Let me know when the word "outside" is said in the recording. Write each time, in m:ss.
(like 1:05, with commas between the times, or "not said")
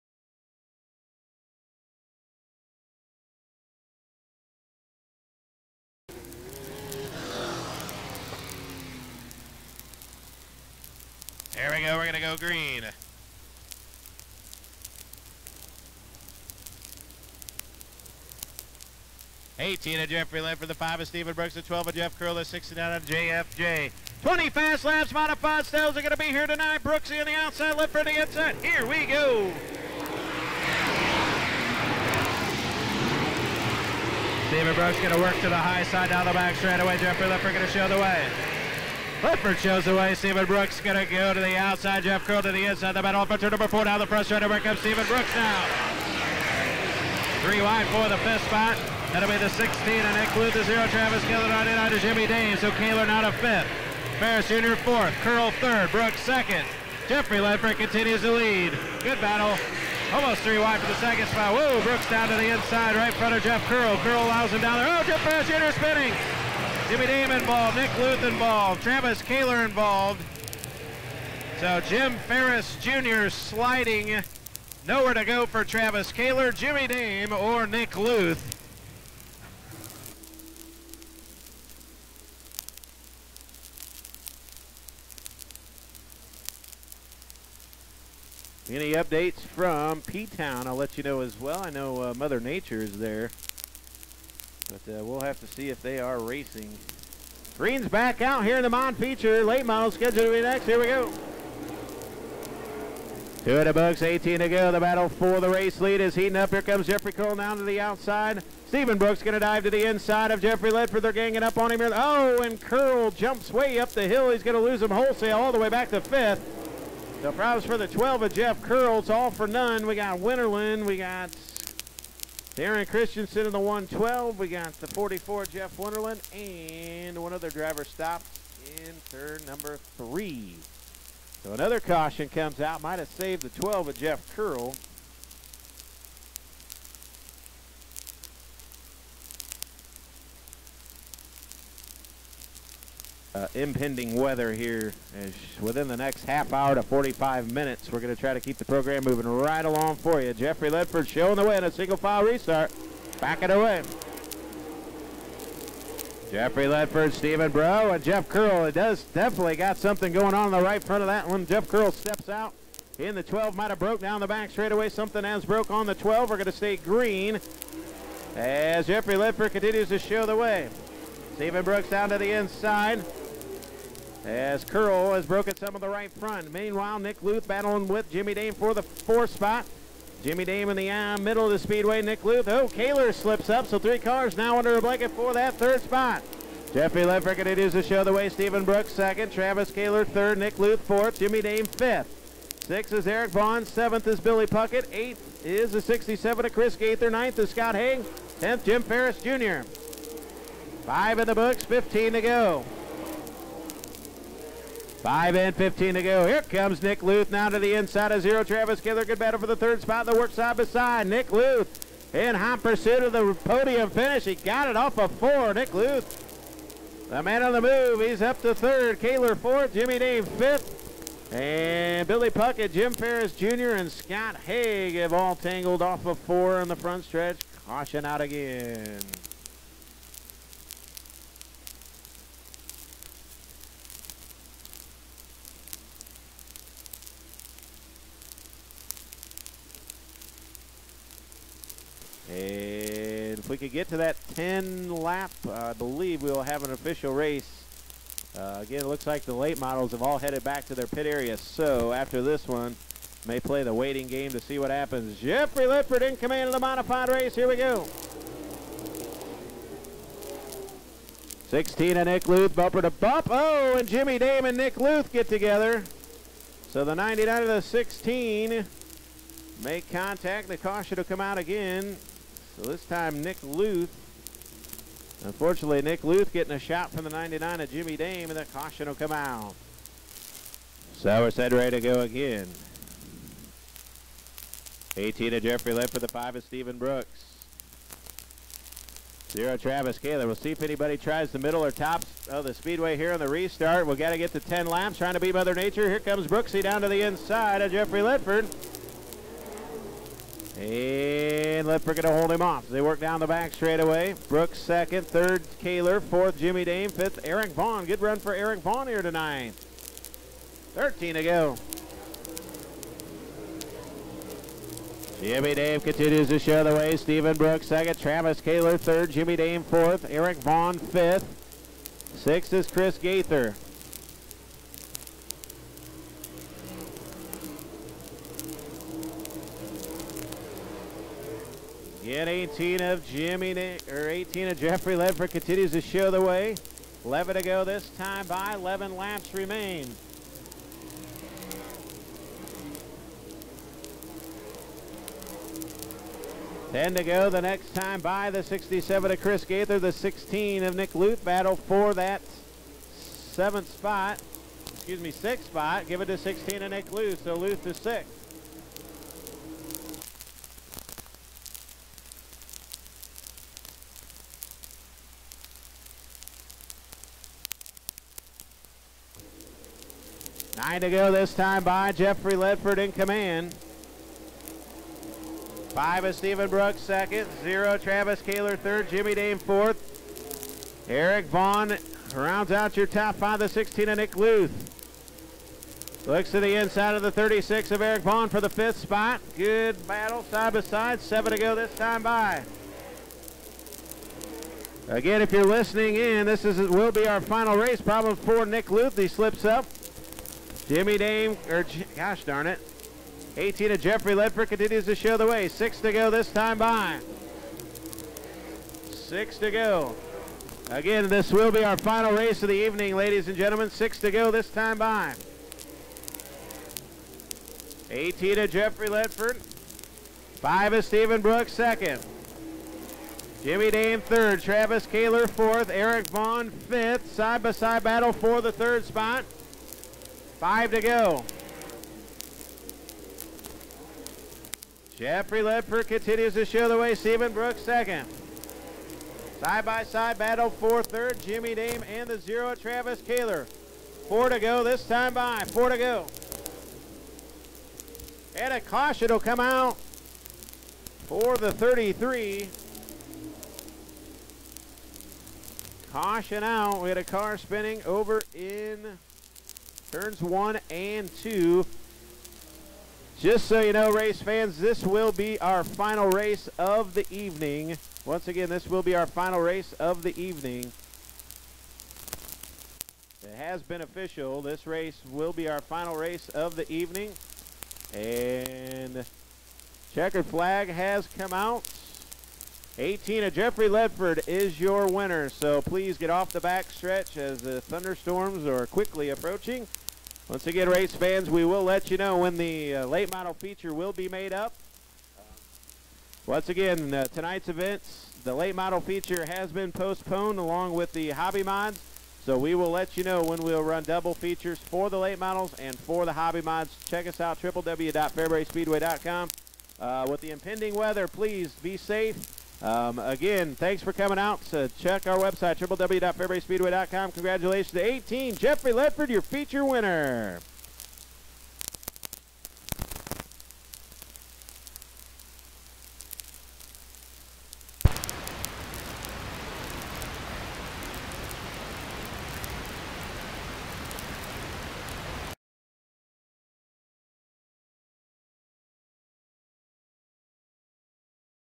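0:27, 0:41, 1:47.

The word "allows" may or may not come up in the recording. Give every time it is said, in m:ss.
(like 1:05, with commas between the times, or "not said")
1:04.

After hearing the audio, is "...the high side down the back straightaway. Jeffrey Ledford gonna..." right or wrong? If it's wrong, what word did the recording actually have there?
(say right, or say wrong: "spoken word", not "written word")
right.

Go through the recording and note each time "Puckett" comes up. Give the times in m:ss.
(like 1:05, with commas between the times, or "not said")
3:14, 3:42.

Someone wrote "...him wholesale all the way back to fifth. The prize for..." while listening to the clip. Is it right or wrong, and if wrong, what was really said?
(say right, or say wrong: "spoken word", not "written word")
right.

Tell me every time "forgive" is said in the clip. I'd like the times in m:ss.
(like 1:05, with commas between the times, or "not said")
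not said.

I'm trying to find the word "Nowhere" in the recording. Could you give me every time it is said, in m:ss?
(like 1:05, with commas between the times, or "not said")
1:14.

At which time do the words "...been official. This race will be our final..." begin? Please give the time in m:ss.
7:53.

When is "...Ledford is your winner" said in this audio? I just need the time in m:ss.
8:03.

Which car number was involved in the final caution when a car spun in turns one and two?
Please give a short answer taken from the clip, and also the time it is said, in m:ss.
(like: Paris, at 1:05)
33, at 7:31.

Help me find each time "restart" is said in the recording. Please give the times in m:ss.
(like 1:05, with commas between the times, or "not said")
2:32, 4:53.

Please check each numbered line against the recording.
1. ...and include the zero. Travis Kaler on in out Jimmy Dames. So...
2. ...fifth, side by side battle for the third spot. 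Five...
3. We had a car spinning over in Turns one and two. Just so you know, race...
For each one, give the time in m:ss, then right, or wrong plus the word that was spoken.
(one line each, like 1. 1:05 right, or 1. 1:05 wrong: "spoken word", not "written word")
1. 0:49 right
2. 7:06 right
3. 7:36 right.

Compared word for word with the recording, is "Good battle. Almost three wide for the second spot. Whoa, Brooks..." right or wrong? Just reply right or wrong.
right.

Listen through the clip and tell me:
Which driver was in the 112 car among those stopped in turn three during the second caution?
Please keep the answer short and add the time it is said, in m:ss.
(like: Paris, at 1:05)
Darren Christensen, at 2:02.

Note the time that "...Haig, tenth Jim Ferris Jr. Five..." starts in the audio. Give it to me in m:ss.
3:17.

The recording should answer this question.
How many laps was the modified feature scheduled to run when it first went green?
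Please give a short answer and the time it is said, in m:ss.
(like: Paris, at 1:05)
20, at 0:24.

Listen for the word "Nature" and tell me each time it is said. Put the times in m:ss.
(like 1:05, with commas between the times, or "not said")
1:32, 4:55.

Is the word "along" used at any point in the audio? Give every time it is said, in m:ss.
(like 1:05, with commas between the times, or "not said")
2:29, 8:20.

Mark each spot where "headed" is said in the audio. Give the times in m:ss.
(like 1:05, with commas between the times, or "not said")
4:10.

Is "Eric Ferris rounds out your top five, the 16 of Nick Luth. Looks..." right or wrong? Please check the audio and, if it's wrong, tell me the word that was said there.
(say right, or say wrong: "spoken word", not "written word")
wrong: "Vaughn", not "Ferris".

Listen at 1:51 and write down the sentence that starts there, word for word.
They're ganging up on him here.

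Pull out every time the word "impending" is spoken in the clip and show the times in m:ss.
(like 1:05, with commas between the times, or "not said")
2:23, 8:30.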